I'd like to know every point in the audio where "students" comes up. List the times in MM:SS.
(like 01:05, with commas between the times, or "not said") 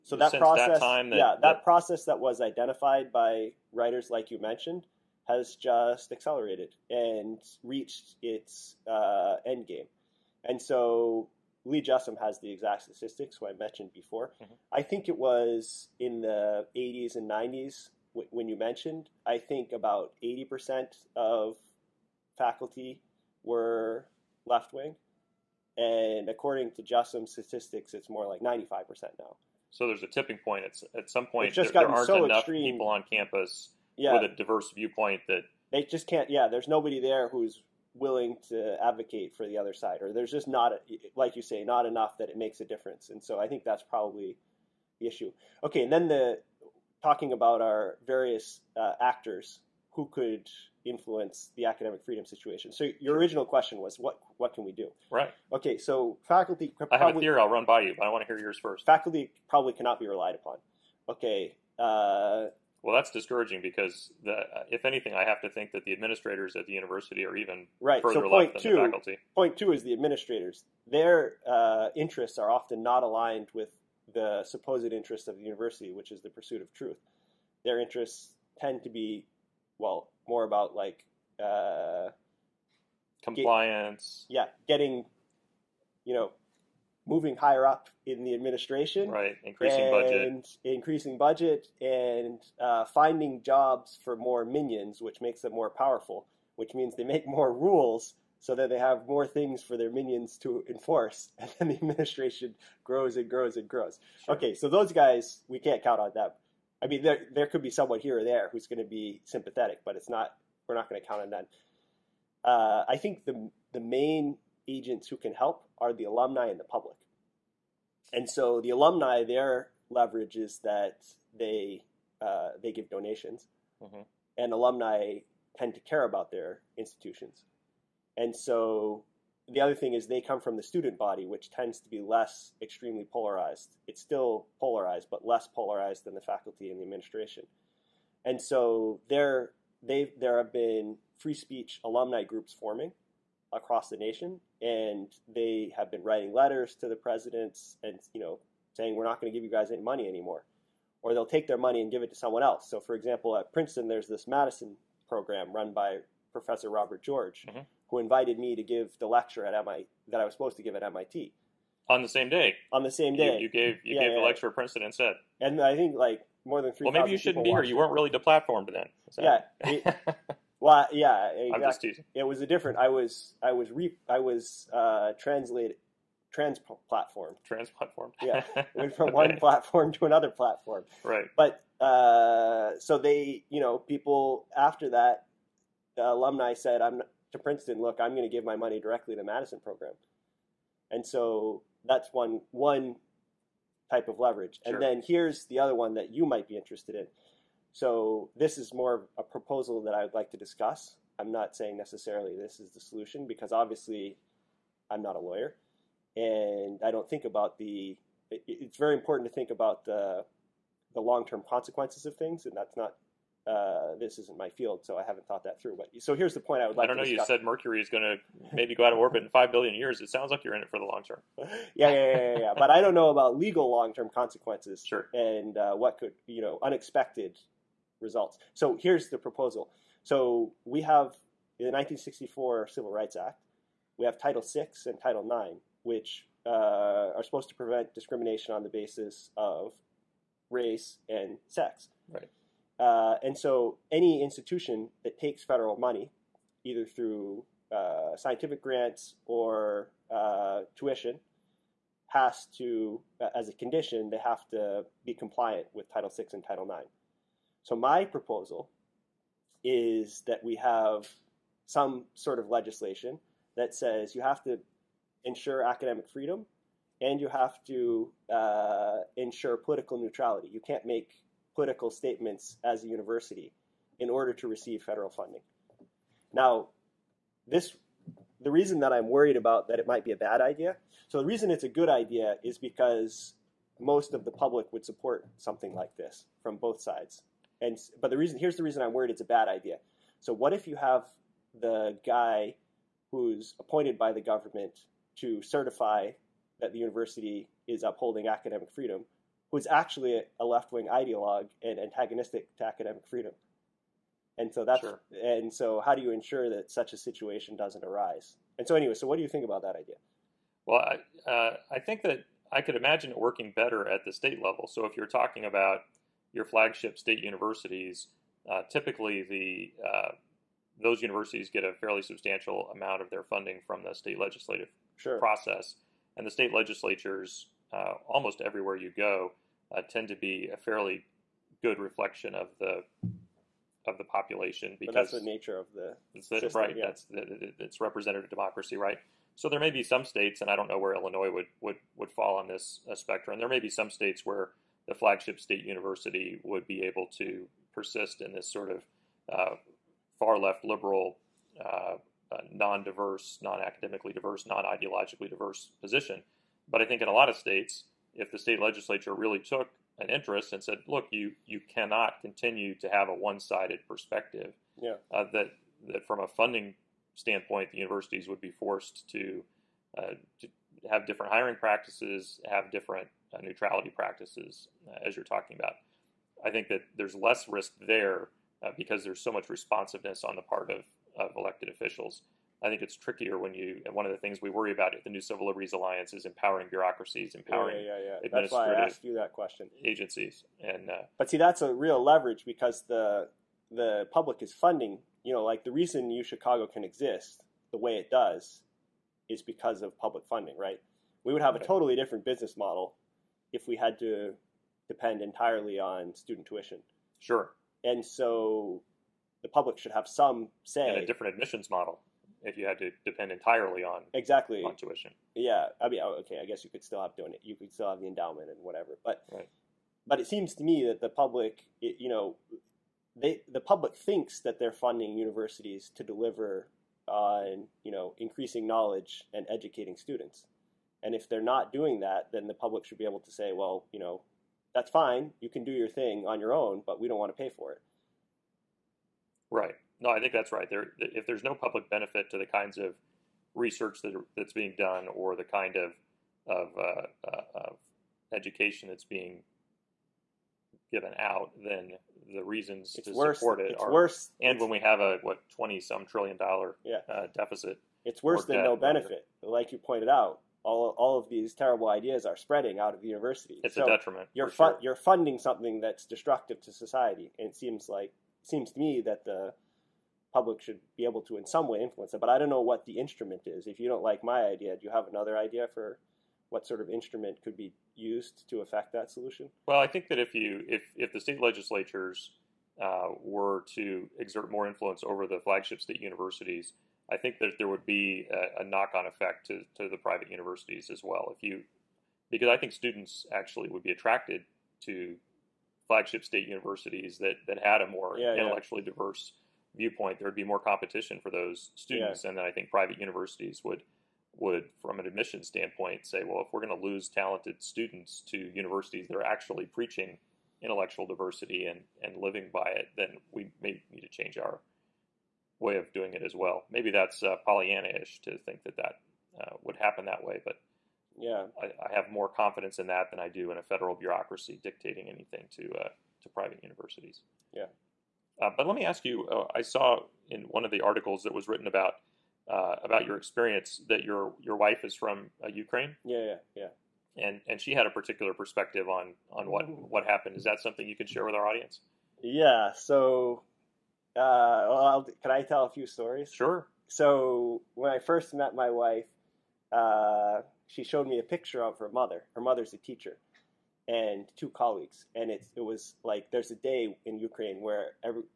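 02:10, 06:46, 07:09, 08:12, 08:21, 08:27.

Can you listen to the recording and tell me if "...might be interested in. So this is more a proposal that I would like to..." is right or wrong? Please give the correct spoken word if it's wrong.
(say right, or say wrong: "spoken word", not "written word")
right.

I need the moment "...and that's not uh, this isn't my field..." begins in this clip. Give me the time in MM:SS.
03:32.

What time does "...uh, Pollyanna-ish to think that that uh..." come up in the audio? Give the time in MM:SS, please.
08:37.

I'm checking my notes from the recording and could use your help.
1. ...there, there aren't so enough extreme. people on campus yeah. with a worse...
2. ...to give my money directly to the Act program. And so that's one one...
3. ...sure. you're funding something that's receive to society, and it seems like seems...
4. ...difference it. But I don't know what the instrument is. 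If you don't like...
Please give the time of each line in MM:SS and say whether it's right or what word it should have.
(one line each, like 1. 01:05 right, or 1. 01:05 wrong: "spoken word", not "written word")
1. 00:31 wrong: "diverse", not "worse"
2. 03:08 wrong: "Madison", not "Act"
3. 07:44 wrong: "destructive", not "receive"
4. 07:51 wrong: "influence", not "difference".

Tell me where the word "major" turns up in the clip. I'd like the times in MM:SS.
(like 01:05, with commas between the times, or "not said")
not said.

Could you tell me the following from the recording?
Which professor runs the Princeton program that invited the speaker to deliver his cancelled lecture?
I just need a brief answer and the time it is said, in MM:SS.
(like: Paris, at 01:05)
Robert George, at 02:36.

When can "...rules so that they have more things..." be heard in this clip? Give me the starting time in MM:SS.
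01:37.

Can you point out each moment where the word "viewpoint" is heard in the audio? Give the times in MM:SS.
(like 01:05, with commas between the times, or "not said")
00:34, 08:19.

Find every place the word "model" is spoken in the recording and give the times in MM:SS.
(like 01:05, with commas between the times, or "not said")
06:42, 06:51.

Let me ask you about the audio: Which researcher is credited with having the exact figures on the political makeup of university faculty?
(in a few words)
Lee Jussim.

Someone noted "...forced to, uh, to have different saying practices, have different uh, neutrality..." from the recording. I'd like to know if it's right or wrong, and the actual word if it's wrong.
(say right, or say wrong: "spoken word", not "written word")
wrong: "hiring", not "saying".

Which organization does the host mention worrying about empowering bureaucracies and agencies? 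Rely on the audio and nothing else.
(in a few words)
New Civil Liberties Alliance.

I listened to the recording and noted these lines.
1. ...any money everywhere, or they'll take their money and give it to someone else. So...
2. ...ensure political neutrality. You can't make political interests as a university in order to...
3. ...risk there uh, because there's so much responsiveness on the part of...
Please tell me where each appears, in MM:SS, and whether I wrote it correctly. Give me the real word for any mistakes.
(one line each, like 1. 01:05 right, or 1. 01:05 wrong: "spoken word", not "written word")
1. 02:29 wrong: "anymore", not "everywhere"
2. 04:29 wrong: "statements", not "interests"
3. 06:17 right.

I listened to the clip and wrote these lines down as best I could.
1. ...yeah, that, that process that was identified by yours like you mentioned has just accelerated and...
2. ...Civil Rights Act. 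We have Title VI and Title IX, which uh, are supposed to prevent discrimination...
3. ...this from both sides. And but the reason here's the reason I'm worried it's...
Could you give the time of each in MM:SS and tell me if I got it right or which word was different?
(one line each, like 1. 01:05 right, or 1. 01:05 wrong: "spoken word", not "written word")
1. 00:01 wrong: "writers", not "yours"
2. 03:52 right
3. 04:45 right.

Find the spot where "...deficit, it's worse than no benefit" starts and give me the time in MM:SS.
07:37.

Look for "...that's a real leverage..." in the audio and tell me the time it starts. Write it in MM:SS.
06:31.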